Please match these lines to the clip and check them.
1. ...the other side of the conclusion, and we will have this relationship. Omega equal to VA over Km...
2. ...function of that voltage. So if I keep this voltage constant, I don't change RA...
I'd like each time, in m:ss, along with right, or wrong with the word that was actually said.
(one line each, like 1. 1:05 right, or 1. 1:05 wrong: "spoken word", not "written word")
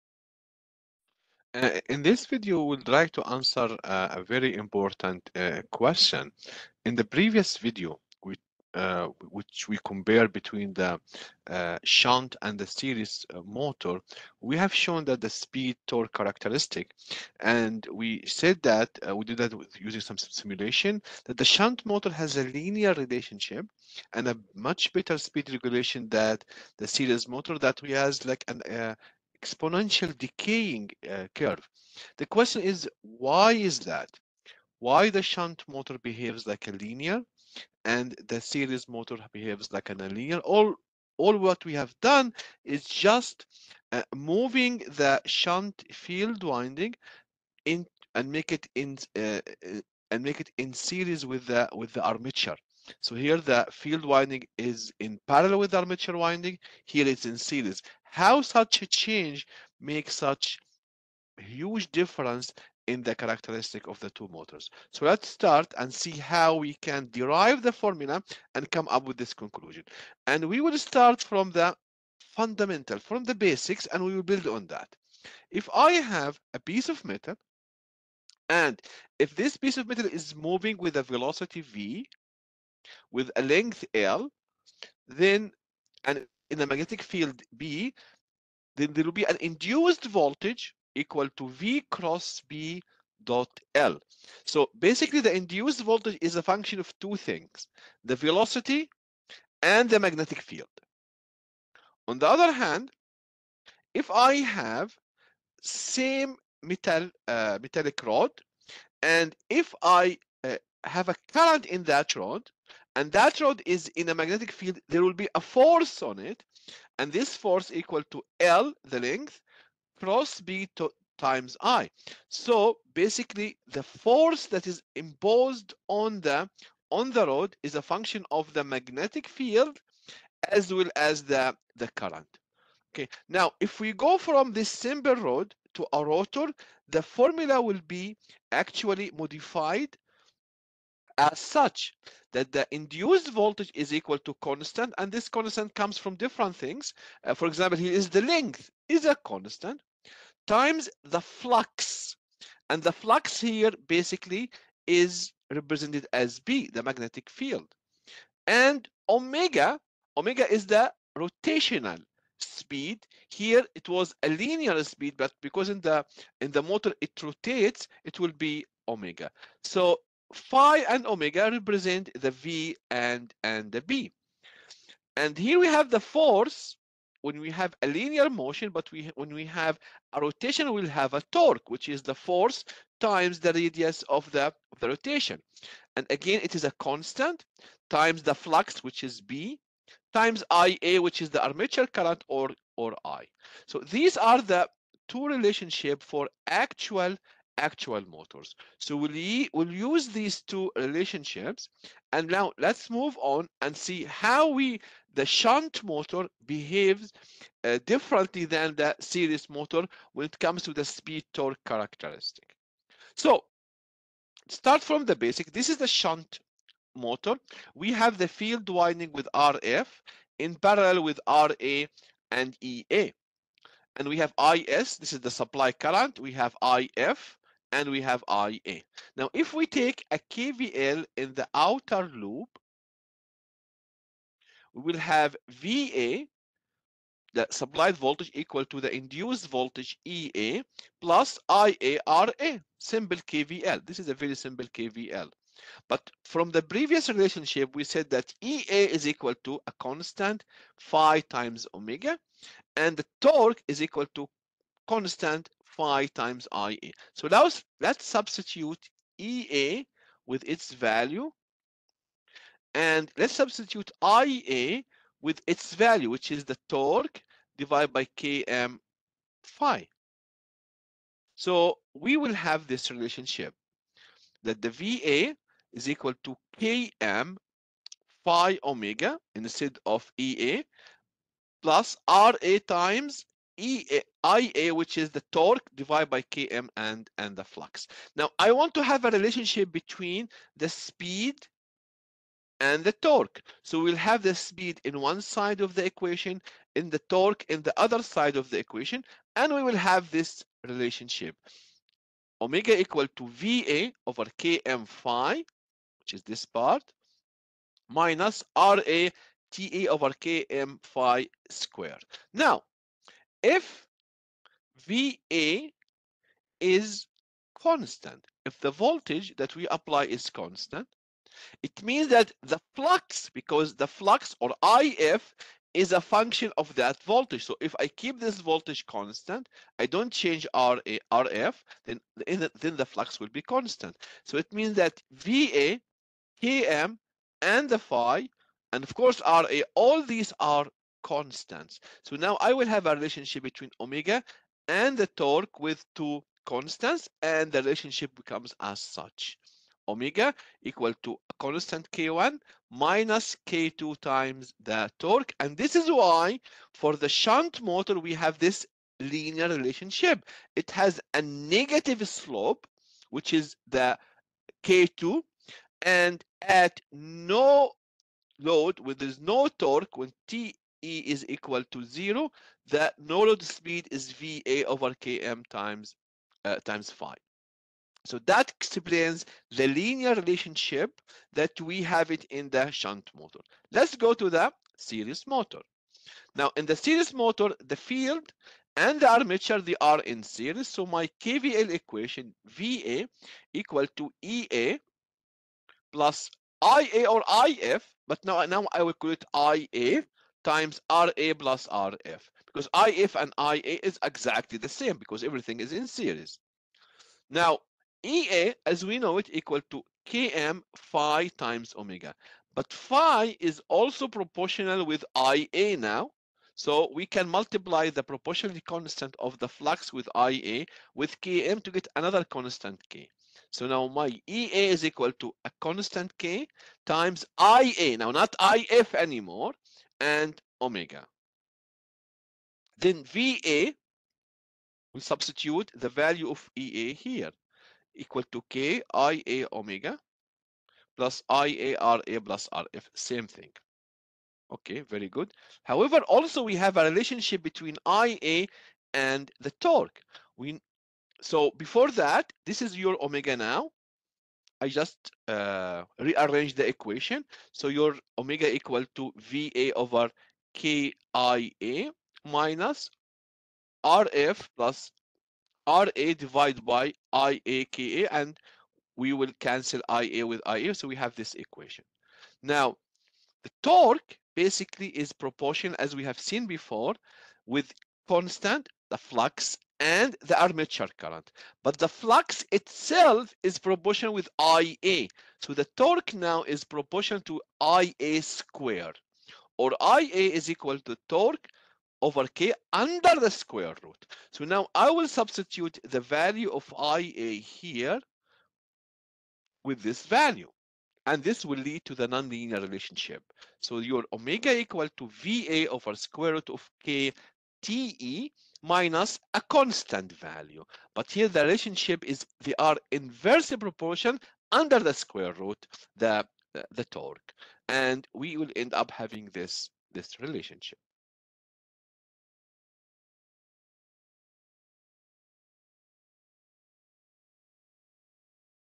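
1. 4:57 wrong: "equation", not "conclusion"
2. 5:26 right.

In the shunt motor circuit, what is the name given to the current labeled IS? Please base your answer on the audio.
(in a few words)
Supply current.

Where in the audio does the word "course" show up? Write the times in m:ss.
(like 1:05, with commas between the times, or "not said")
5:38.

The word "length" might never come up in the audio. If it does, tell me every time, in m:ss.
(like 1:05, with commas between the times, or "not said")
1:23, 1:58, 2:28.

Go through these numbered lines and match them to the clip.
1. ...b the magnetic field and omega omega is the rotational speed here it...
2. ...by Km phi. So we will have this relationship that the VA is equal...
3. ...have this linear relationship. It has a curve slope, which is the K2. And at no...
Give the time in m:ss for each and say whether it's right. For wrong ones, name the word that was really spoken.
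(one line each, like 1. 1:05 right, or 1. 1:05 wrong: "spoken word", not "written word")
1. 2:36 right
2. 4:27 right
3. 5:58 wrong: "negative", not "curve".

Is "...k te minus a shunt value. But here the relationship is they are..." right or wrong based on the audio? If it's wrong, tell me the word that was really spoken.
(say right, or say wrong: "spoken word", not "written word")
wrong: "constant", not "shunt".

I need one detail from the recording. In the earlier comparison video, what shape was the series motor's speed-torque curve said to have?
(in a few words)
Exponential decaying.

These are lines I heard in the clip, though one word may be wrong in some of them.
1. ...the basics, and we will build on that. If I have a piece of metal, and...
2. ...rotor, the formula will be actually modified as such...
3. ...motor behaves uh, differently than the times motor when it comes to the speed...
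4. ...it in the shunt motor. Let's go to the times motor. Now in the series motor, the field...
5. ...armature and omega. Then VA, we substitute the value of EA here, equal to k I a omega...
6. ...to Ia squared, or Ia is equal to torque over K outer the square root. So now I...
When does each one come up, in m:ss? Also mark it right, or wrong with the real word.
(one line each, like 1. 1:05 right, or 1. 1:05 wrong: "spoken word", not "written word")
1. 1:13 right
2. 2:16 right
3. 3:25 wrong: "series", not "times"
4. 6:22 wrong: "series", not "times"
5. 7:08 wrong: "anymore", not "armature"
6. 8:07 wrong: "under", not "outer".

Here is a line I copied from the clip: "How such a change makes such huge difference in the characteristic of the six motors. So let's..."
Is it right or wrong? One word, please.
wrong.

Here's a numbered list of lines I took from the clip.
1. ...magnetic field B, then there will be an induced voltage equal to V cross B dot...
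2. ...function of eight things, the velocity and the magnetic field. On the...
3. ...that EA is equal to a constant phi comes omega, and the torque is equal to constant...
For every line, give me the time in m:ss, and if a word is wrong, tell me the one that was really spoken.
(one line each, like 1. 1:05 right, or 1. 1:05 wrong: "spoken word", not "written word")
1. 1:26 right
2. 1:36 wrong: "two", not "eight"
3. 4:08 wrong: "times", not "comes".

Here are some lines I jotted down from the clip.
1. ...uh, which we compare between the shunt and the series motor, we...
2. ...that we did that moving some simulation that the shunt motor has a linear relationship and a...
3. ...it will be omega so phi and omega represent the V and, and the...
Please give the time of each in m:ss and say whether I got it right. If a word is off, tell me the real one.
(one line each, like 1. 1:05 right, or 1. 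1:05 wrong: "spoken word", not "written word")
1. 0:08 right
2. 0:18 wrong: "using", not "moving"
3. 2:48 right.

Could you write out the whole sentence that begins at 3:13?
So these are the two relationship for actual actual motors.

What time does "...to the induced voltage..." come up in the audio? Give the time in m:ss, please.
3:58.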